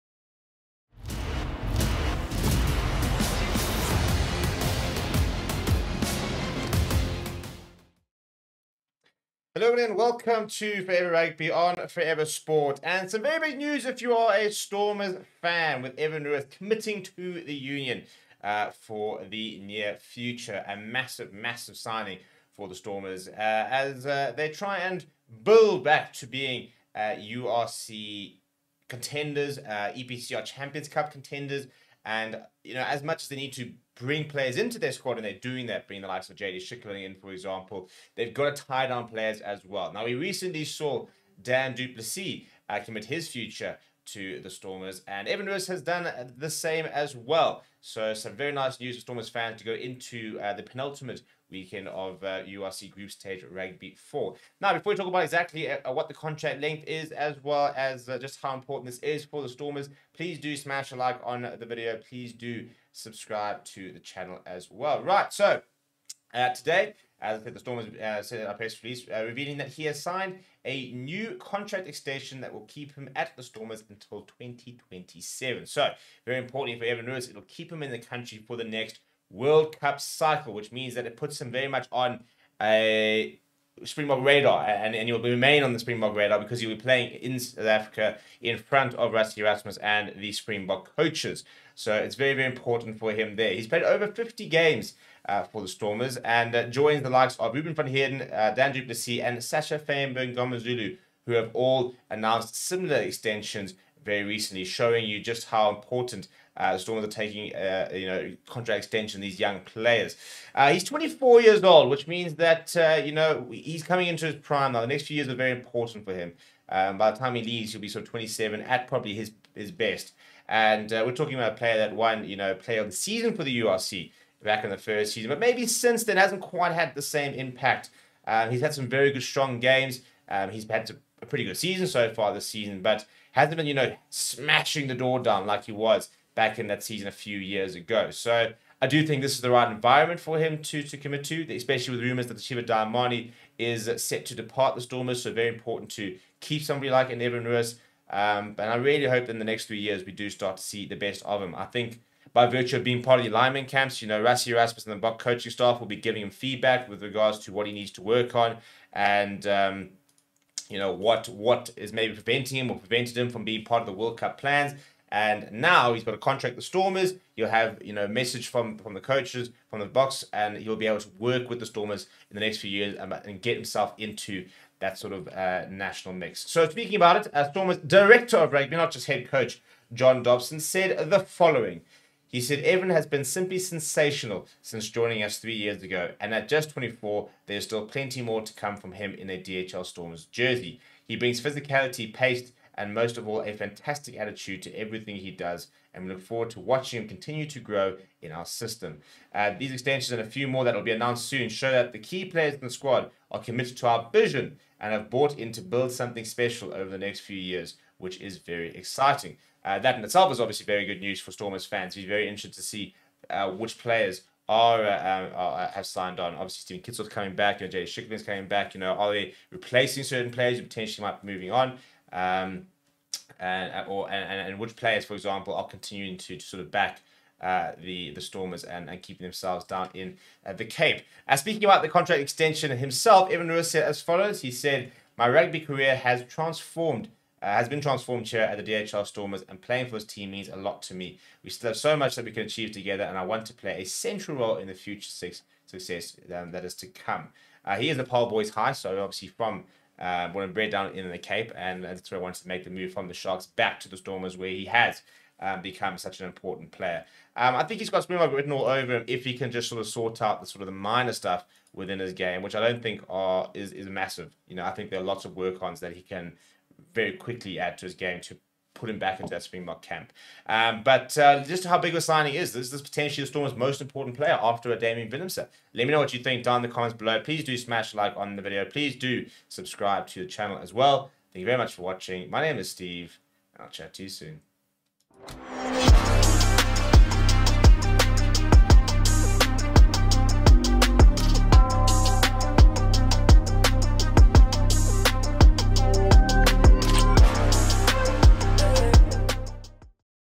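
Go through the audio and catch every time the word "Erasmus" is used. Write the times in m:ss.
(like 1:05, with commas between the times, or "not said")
1:29, 2:34.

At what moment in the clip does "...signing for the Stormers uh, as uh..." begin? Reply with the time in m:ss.
0:21.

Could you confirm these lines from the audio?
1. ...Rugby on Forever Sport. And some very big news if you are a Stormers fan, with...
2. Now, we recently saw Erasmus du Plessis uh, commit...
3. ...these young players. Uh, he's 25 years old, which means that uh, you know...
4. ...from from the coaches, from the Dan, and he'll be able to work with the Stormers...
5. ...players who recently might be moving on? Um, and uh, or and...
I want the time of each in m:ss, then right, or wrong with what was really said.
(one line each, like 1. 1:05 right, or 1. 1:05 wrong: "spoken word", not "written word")
1. 0:11 right
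2. 0:39 wrong: "Dan", not "Erasmus"
3. 1:49 wrong: "24", not "25"
4. 2:48 wrong: "Boks", not "Dan"
5. 3:40 wrong: "potentially", not "recently".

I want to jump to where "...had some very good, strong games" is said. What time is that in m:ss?
2:08.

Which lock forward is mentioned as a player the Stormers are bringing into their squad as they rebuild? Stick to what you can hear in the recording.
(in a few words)
JD Schickerling.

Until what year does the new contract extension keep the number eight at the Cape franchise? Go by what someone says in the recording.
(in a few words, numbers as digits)
2027.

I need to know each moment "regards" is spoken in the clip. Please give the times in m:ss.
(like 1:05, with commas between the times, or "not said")
2:37.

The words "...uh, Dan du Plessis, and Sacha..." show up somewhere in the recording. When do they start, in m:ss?
1:38.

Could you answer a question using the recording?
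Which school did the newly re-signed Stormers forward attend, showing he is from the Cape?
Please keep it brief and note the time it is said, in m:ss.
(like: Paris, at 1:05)
Paarl Boys High, at 4:08.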